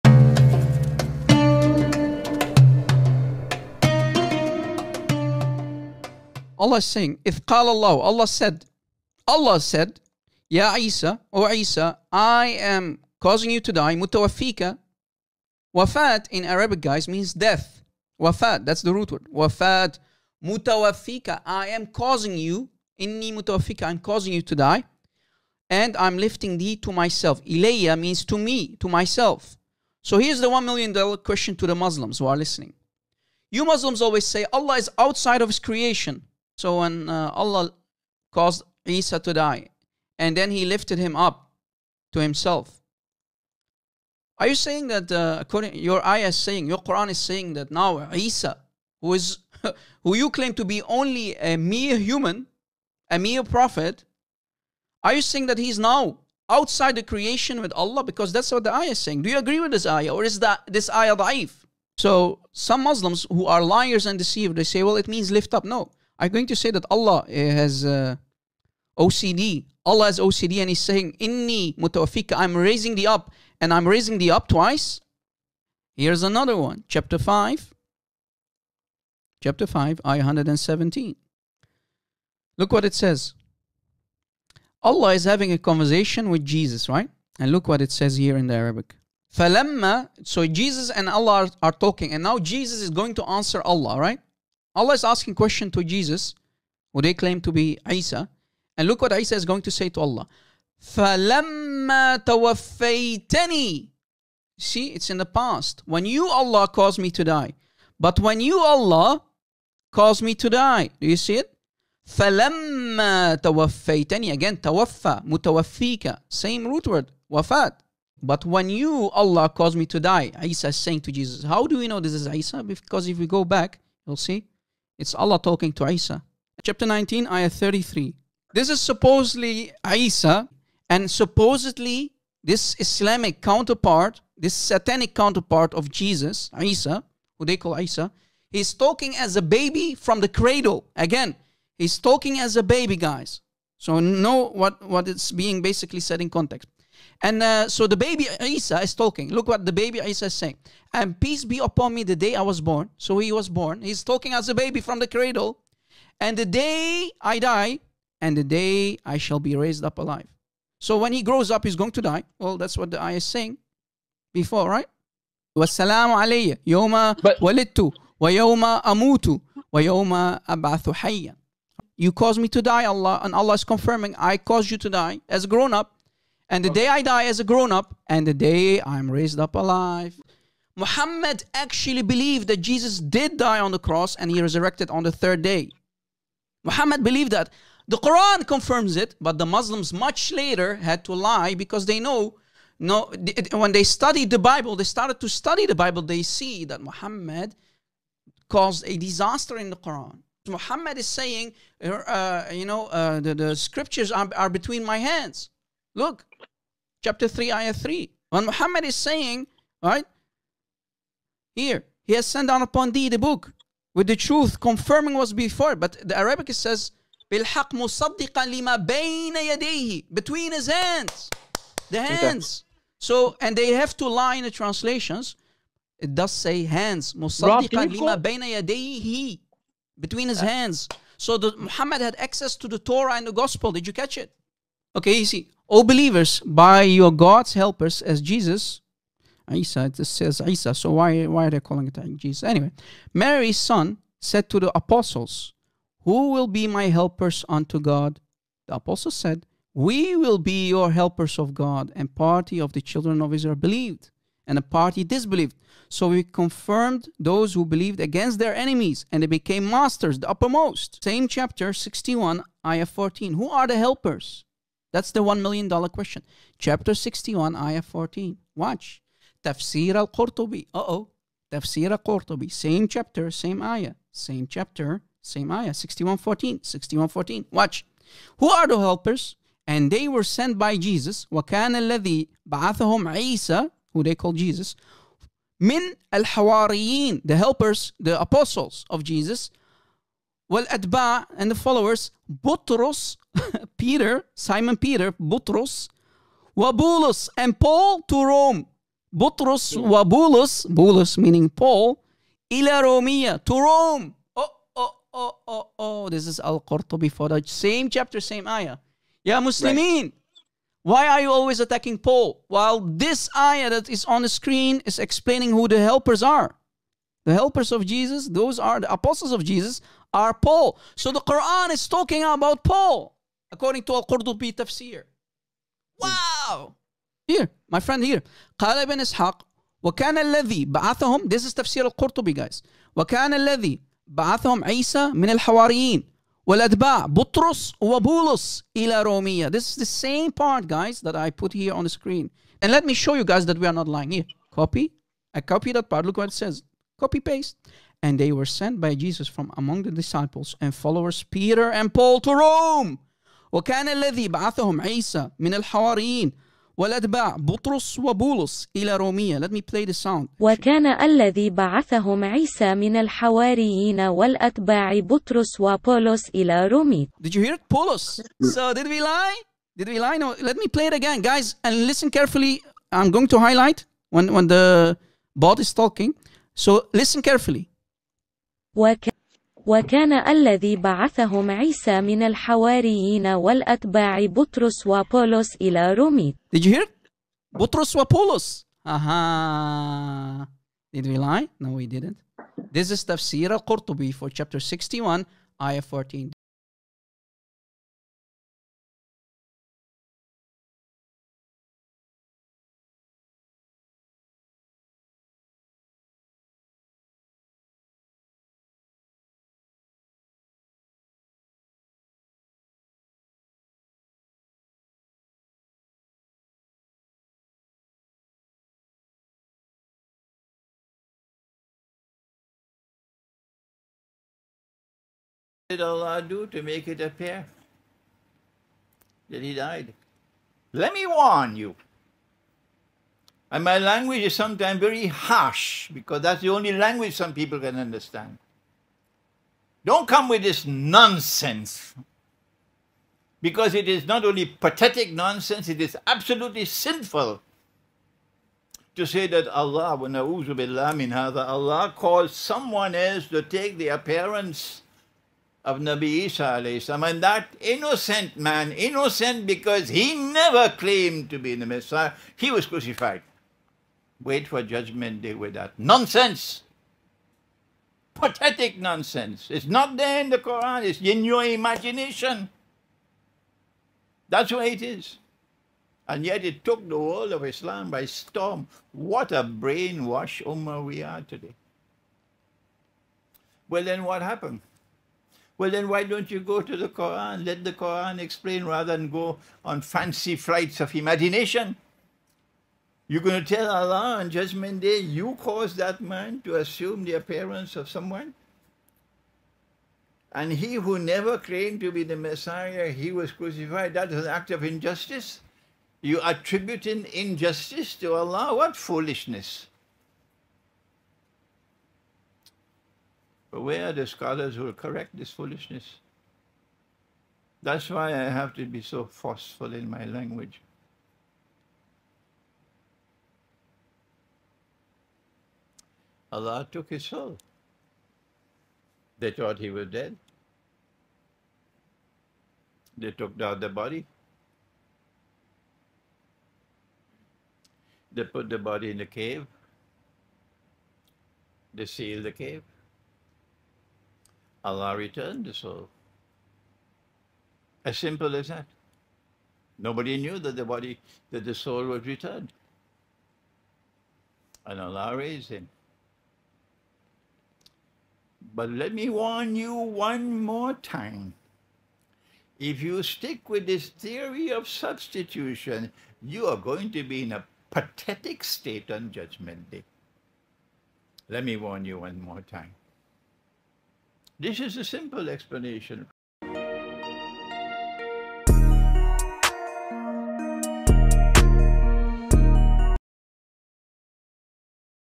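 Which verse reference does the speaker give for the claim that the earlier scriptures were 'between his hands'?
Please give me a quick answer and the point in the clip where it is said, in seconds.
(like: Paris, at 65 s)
Chapter 3, ayah 3, at 207 s.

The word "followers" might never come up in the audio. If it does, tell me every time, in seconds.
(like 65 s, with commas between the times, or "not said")
291 s, 350 s.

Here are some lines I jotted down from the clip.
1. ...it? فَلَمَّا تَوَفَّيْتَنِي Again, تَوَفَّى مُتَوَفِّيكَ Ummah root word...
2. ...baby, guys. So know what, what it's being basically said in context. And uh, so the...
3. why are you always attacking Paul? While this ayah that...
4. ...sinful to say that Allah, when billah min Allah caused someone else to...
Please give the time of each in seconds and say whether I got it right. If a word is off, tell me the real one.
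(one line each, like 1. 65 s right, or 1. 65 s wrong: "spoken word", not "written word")
1. 111 s wrong: "Same", not "Ummah"
2. 142 s right
3. 310 s right
4. 446 s right.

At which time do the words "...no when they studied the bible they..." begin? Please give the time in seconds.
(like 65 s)
192 s.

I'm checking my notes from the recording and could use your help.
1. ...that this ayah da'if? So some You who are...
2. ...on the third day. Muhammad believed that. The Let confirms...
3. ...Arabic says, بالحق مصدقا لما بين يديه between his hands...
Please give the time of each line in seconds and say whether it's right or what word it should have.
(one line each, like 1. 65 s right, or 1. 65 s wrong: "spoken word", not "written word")
1. 60 s wrong: "Muslims", not "You"
2. 184 s wrong: "Quran", not "Let"
3. 216 s right.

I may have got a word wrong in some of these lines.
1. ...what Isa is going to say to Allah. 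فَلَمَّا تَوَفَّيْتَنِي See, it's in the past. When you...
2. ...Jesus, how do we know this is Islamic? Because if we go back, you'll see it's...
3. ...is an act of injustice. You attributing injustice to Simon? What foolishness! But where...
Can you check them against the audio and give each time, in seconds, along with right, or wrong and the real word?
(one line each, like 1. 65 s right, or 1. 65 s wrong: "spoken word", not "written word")
1. 99 s right
2. 121 s wrong: "Isa", not "Islamic"
3. 504 s wrong: "Allah", not "Simon".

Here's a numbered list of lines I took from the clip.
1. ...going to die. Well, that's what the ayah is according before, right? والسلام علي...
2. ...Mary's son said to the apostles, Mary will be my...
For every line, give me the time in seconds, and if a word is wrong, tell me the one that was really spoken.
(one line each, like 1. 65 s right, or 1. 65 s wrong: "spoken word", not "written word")
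1. 161 s wrong: "saying", not "according"
2. 243 s wrong: "Who", not "Mary".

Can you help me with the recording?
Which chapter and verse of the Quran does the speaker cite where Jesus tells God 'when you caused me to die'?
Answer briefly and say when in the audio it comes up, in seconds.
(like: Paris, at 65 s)
Chapter 5, ayah 117, at 79 s.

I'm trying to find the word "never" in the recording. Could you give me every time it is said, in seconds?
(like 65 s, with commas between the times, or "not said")
460 s, 500 s.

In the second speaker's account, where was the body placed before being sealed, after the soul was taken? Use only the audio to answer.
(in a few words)
A cave.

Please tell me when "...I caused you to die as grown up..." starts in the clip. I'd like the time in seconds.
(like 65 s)
174 s.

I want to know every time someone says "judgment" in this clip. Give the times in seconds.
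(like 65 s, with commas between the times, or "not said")
464 s, 494 s, 569 s.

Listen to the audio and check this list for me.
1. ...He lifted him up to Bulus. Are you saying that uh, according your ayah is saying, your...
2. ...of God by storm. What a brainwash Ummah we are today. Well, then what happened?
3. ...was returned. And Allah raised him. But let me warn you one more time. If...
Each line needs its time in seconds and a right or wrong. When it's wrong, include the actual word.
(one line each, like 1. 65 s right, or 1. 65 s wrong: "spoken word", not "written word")
1. 40 s wrong: "Himself", not "Bulus"
2. 477 s wrong: "Islam", not "God"
3. 551 s right.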